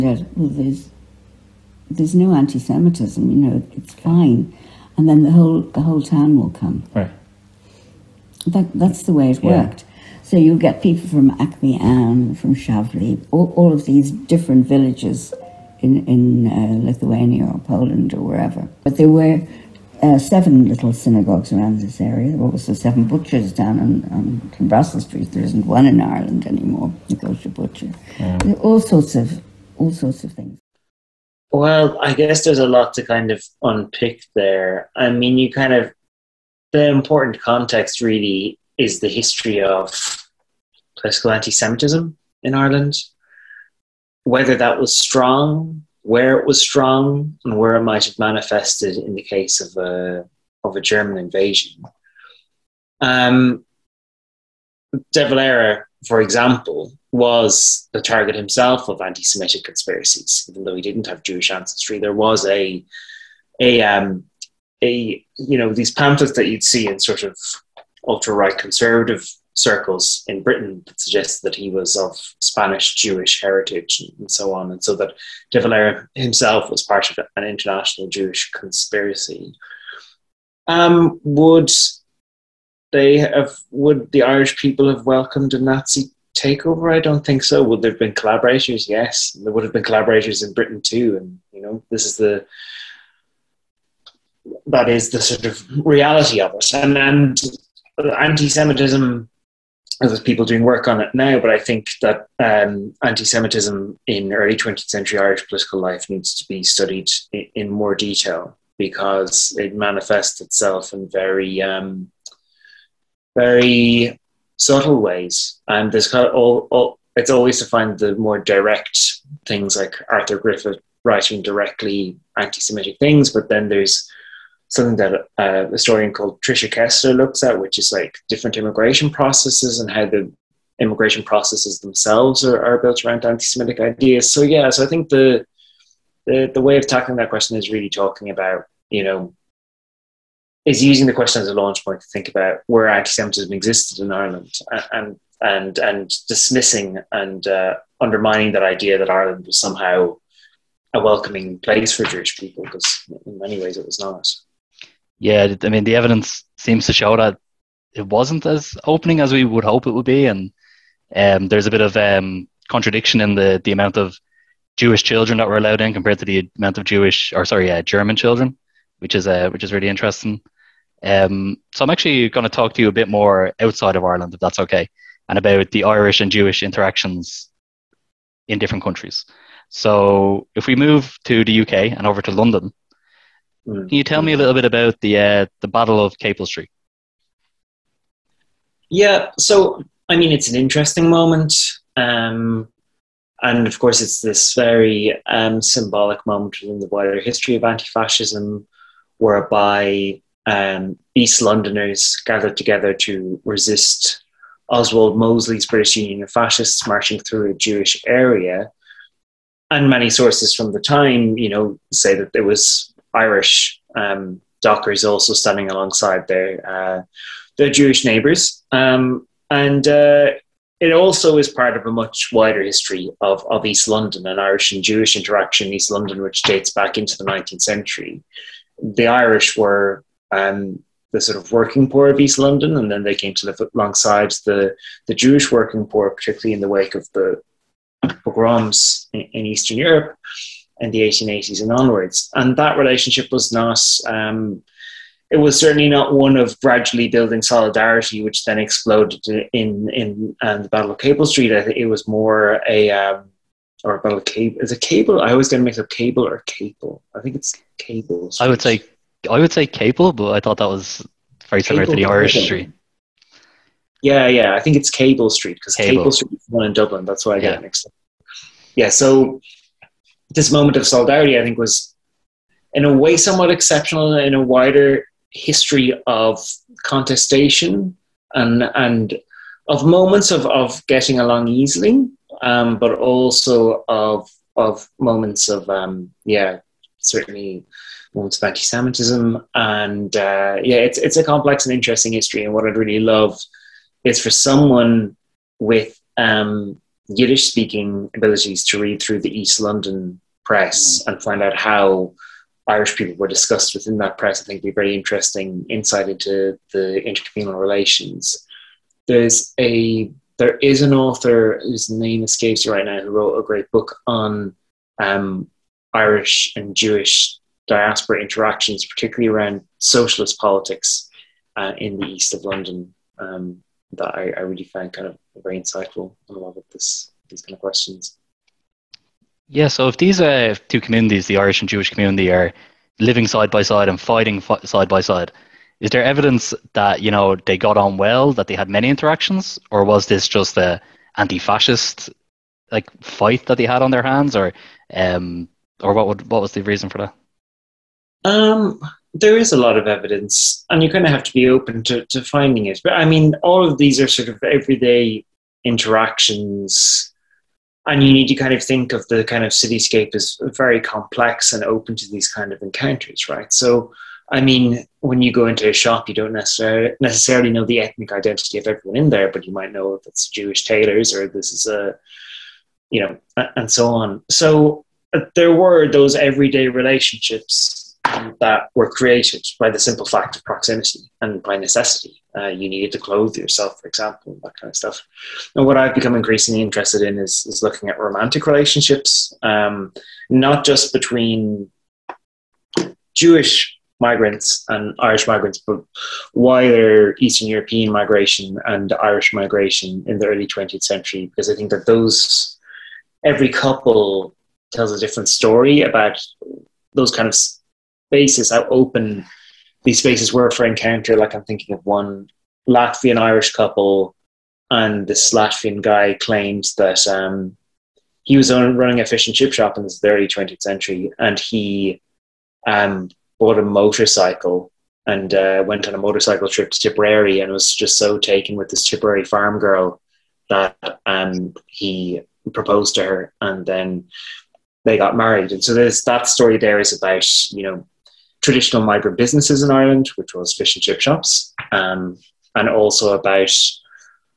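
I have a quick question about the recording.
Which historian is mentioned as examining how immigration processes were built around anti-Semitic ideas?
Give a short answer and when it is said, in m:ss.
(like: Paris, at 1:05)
Tricia Kessler, at 2:06.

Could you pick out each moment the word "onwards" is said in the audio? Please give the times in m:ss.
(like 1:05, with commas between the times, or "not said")
4:01.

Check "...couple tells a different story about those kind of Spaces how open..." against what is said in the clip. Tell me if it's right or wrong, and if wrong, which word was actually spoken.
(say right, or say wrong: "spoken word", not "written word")
right.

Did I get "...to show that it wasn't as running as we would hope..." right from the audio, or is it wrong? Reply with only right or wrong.
wrong.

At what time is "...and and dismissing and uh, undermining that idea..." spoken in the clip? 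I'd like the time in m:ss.
2:25.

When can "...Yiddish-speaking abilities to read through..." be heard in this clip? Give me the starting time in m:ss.
4:57.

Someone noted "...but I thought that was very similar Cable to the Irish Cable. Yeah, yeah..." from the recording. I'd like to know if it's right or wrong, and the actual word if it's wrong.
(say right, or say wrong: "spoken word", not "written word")
wrong: "Street", not "Cable".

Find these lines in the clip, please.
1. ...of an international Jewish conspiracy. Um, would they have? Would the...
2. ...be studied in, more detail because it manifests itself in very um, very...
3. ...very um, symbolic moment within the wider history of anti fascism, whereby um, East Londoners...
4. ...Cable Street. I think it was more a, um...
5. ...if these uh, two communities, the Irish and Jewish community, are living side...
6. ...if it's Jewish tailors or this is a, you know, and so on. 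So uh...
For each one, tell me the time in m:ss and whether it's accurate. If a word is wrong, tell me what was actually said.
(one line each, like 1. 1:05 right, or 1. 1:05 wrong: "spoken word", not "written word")
1. 1:17 right
2. 1:46 right
3. 3:14 right
4. 4:10 right
5. 5:29 right
6. 6:09 right.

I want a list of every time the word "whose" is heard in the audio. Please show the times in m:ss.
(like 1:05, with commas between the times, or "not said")
5:11.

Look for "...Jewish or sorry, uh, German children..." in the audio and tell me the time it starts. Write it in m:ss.
2:46.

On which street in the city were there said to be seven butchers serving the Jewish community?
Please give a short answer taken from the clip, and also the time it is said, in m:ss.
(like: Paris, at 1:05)
Russell Street, at 0:24.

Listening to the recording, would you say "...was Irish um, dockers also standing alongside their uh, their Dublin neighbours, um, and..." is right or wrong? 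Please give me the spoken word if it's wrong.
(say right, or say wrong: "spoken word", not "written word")
wrong: "Jewish", not "Dublin".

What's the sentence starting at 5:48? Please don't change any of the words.
Um, there is a lot of evidence, and you kind of have to be open to, to finding it.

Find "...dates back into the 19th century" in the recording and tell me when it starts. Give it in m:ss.
3:46.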